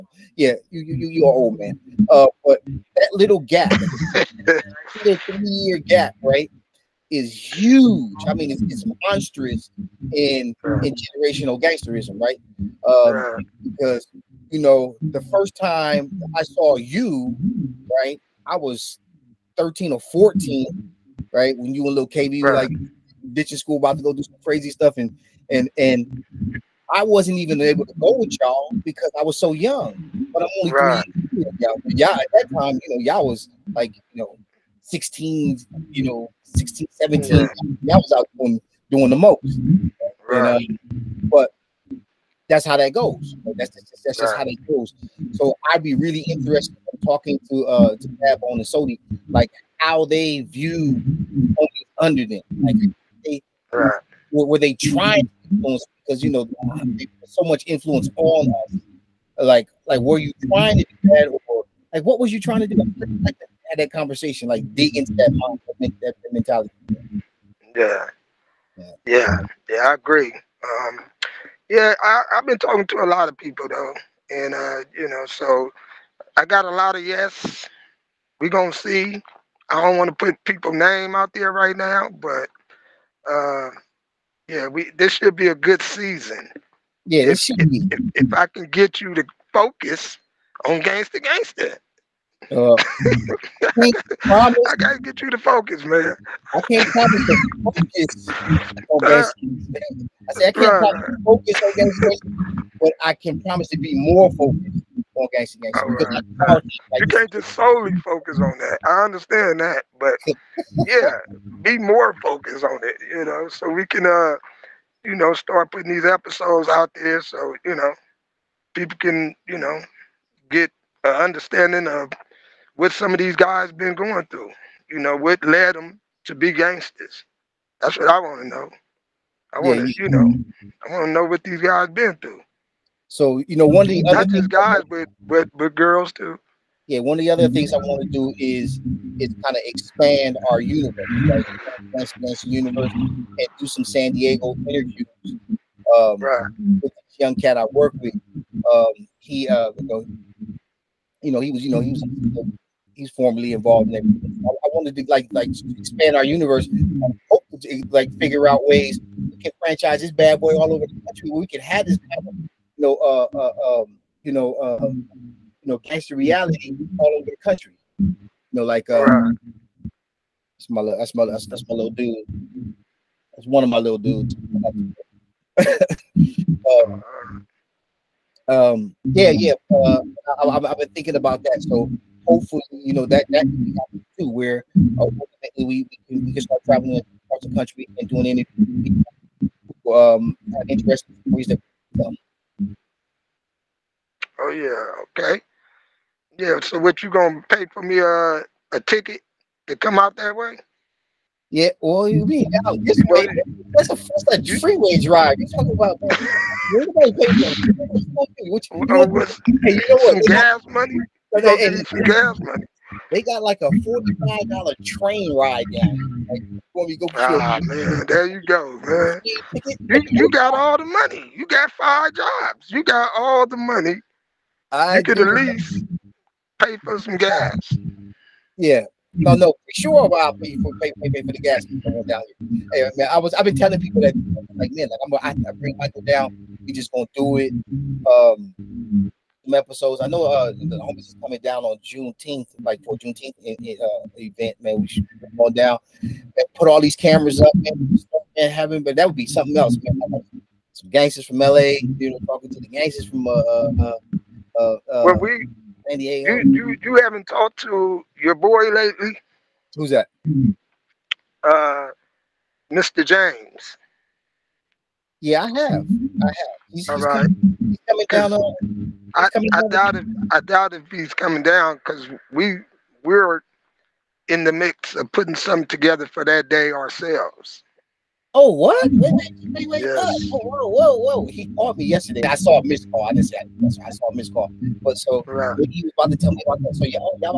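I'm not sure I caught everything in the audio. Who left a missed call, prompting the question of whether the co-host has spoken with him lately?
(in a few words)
Mr. James.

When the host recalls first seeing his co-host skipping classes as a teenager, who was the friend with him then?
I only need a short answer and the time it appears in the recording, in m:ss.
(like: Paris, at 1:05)
Little KB, at 0:21.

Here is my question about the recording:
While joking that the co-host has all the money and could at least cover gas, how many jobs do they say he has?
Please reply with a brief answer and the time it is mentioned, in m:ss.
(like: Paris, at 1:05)
5, at 3:41.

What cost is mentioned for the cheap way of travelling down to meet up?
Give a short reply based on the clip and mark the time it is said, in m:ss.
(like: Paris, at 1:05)
45 dollars, at 3:33.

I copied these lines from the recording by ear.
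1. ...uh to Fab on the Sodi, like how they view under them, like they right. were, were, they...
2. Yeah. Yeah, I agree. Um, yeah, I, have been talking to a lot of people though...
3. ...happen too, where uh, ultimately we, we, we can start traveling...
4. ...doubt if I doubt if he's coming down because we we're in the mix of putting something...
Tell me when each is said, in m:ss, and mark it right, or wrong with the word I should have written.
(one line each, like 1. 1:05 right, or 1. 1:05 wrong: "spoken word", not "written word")
1. 0:47 right
2. 1:09 right
3. 3:03 right
4. 4:29 right.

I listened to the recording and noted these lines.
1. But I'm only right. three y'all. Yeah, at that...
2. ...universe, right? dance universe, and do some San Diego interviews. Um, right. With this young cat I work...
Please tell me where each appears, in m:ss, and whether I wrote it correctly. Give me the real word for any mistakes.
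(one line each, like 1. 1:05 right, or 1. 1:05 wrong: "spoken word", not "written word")
1. 0:30 right
2. 2:20 right.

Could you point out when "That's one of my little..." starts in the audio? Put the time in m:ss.
2:53.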